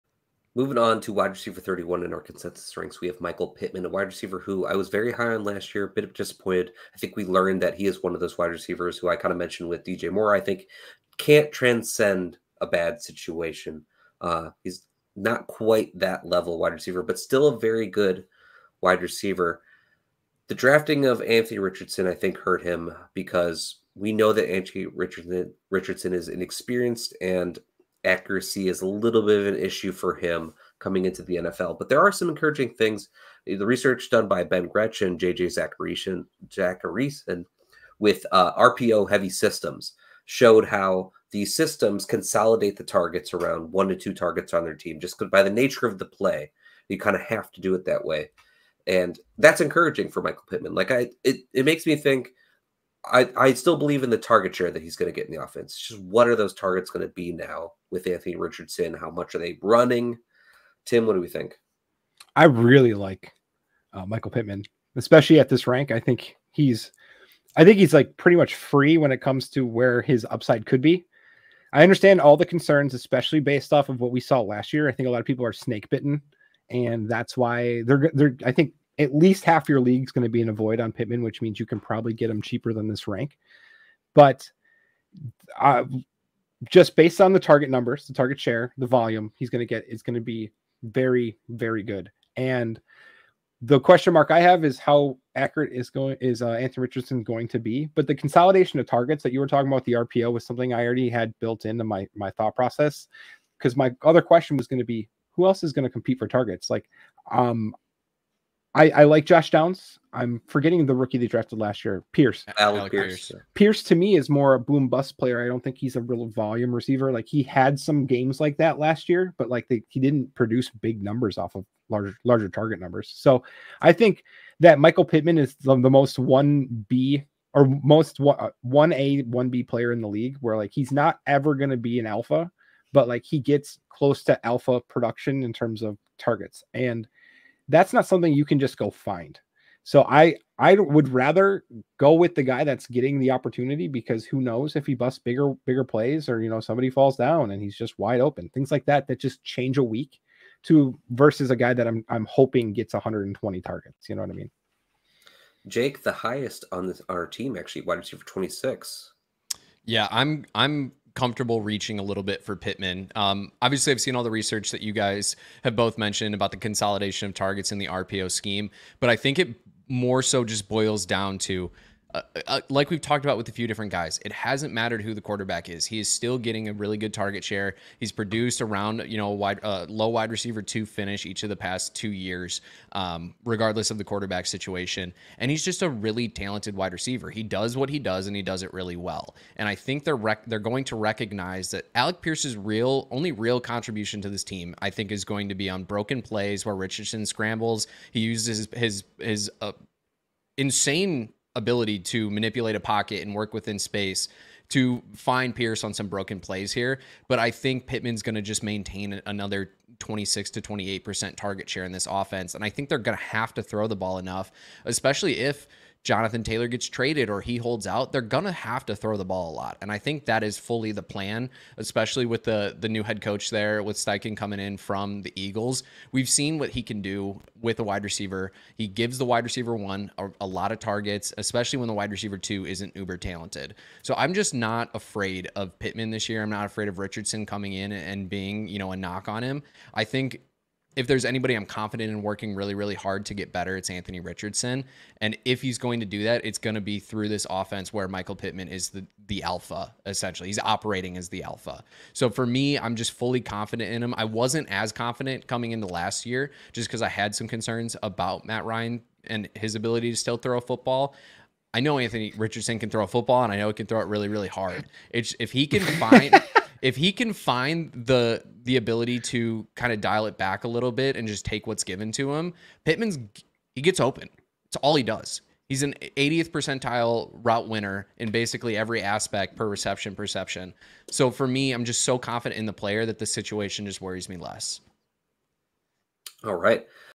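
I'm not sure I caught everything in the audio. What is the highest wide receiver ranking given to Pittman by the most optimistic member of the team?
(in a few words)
26.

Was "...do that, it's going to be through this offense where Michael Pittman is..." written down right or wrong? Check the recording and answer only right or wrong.
right.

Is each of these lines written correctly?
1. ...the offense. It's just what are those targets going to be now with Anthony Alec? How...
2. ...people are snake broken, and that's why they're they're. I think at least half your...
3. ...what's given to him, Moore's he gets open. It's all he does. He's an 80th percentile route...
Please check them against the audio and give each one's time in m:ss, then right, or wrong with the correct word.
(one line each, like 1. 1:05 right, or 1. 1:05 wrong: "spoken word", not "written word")
1. 0:55 wrong: "Richardson", not "Alec"
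2. 1:15 wrong: "bitten", not "broken"
3. 4:31 wrong: "Pittman", not "Moore".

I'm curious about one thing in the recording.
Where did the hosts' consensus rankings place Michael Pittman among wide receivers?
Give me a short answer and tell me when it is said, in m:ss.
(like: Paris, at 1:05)
31, at 0:01.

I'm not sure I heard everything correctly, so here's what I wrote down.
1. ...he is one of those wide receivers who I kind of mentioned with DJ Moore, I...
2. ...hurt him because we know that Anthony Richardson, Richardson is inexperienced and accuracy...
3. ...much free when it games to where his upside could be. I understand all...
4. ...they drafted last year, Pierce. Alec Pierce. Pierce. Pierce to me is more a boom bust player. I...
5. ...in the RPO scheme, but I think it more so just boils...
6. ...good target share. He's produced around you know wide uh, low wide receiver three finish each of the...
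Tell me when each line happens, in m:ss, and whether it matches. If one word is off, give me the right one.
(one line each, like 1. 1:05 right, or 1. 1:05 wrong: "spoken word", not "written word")
1. 0:07 right
2. 0:22 right
3. 1:08 wrong: "comes", not "games"
4. 1:51 right
5. 2:47 right
6. 2:56 wrong: "two", not "three".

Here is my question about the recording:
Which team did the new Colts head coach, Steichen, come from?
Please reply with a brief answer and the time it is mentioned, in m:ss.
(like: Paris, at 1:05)
the Eagles, at 3:45.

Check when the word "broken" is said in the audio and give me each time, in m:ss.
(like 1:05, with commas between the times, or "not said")
3:15, 3:26.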